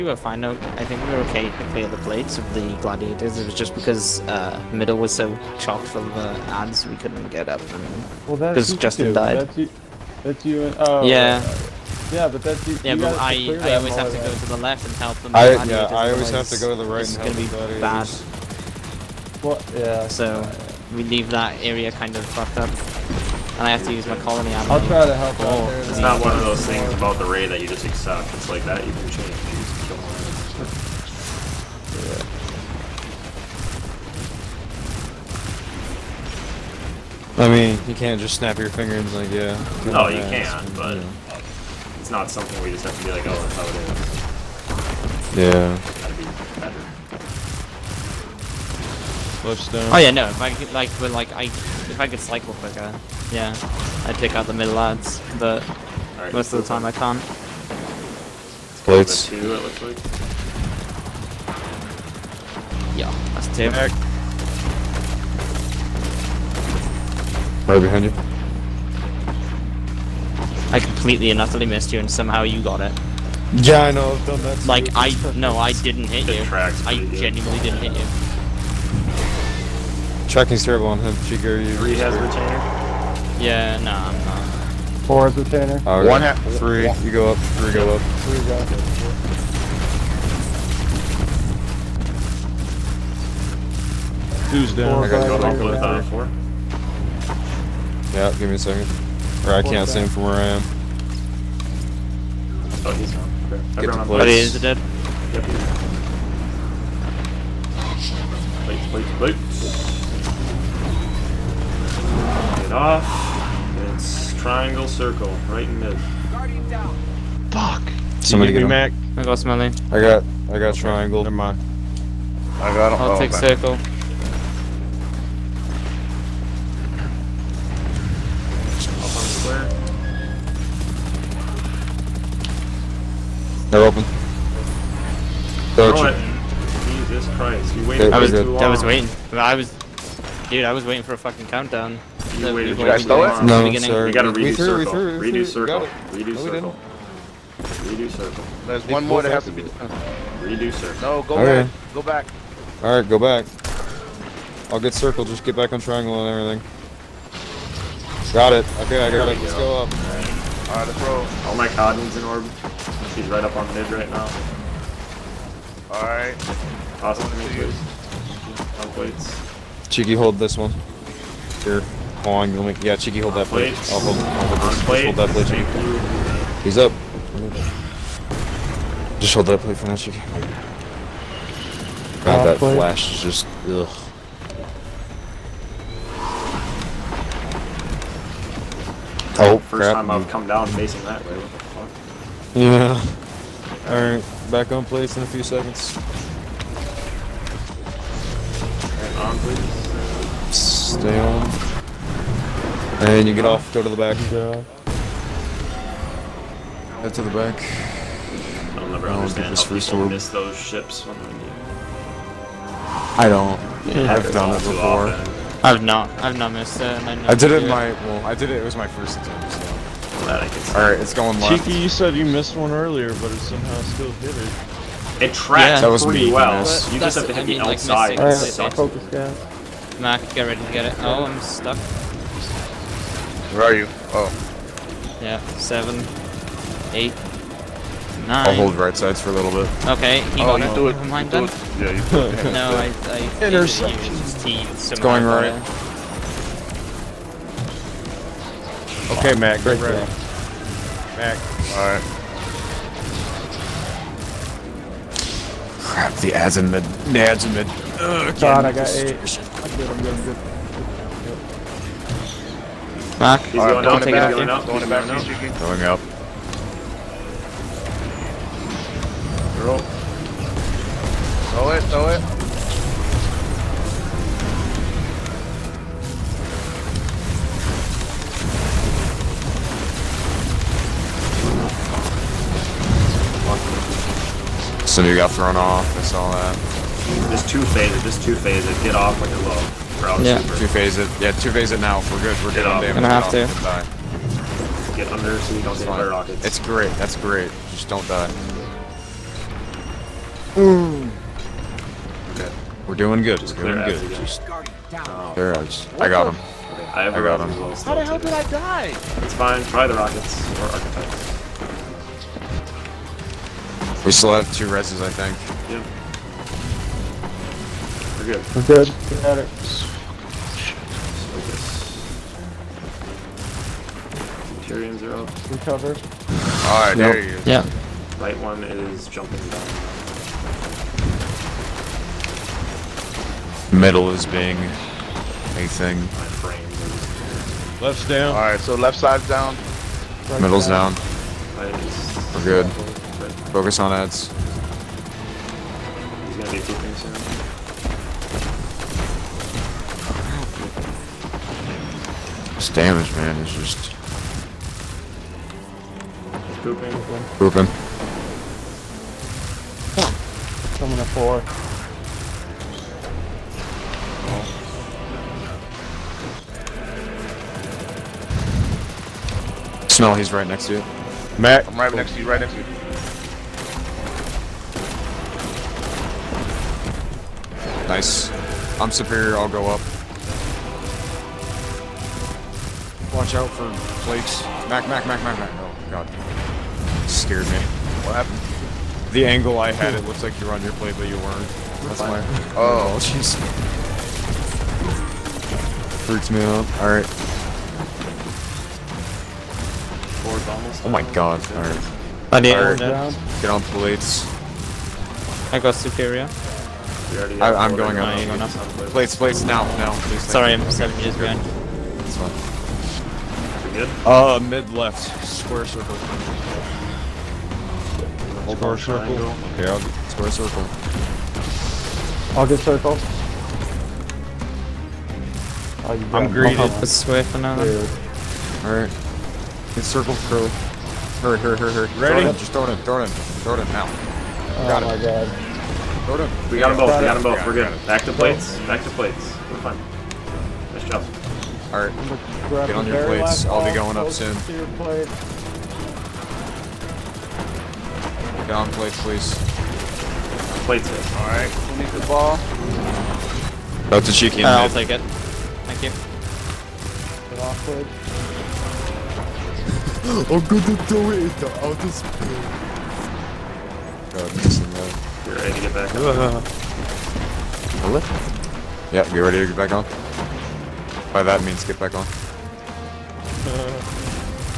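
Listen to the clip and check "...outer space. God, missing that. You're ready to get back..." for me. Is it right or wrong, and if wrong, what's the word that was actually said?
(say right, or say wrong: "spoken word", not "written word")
right.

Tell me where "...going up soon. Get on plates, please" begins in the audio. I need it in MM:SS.
07:23.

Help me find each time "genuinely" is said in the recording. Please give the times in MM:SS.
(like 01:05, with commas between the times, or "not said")
01:17.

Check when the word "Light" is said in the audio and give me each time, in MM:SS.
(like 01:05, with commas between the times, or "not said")
05:28.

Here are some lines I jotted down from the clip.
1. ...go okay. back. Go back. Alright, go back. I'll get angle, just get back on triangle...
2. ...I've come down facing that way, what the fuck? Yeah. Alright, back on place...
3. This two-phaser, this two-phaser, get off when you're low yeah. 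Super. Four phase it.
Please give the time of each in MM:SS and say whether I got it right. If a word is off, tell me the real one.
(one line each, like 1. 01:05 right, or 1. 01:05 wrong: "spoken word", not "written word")
1. 02:31 wrong: "circle", not "angle"
2. 03:10 right
3. 04:47 wrong: "Two", not "Four".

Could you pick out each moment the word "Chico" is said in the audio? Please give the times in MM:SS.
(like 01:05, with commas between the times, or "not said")
01:21.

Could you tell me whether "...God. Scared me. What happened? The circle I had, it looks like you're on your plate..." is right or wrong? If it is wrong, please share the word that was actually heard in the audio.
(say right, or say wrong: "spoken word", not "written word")
wrong: "angle", not "circle".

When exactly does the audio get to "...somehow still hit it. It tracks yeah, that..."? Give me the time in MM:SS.
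03:43.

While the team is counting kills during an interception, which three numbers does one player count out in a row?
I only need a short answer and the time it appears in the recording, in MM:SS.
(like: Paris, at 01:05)
7, 8, 9, at 03:55.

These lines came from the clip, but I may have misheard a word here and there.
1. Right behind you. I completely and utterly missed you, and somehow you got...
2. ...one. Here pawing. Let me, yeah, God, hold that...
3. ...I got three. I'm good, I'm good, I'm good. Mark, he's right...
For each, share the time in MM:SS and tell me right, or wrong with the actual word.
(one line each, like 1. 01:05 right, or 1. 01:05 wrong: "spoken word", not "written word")
1. 01:07 right
2. 02:50 wrong: "Cheeky", not "God"
3. 04:18 wrong: "eight", not "three".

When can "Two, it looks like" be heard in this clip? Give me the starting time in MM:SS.
00:59.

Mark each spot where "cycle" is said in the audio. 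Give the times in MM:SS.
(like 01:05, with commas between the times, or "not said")
00:52.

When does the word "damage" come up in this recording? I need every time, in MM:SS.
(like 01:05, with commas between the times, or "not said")
04:52, 05:52.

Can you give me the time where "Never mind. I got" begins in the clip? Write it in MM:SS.
02:01.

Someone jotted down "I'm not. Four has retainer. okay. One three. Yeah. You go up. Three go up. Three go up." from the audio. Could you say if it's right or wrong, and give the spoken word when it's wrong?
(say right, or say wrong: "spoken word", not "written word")
right.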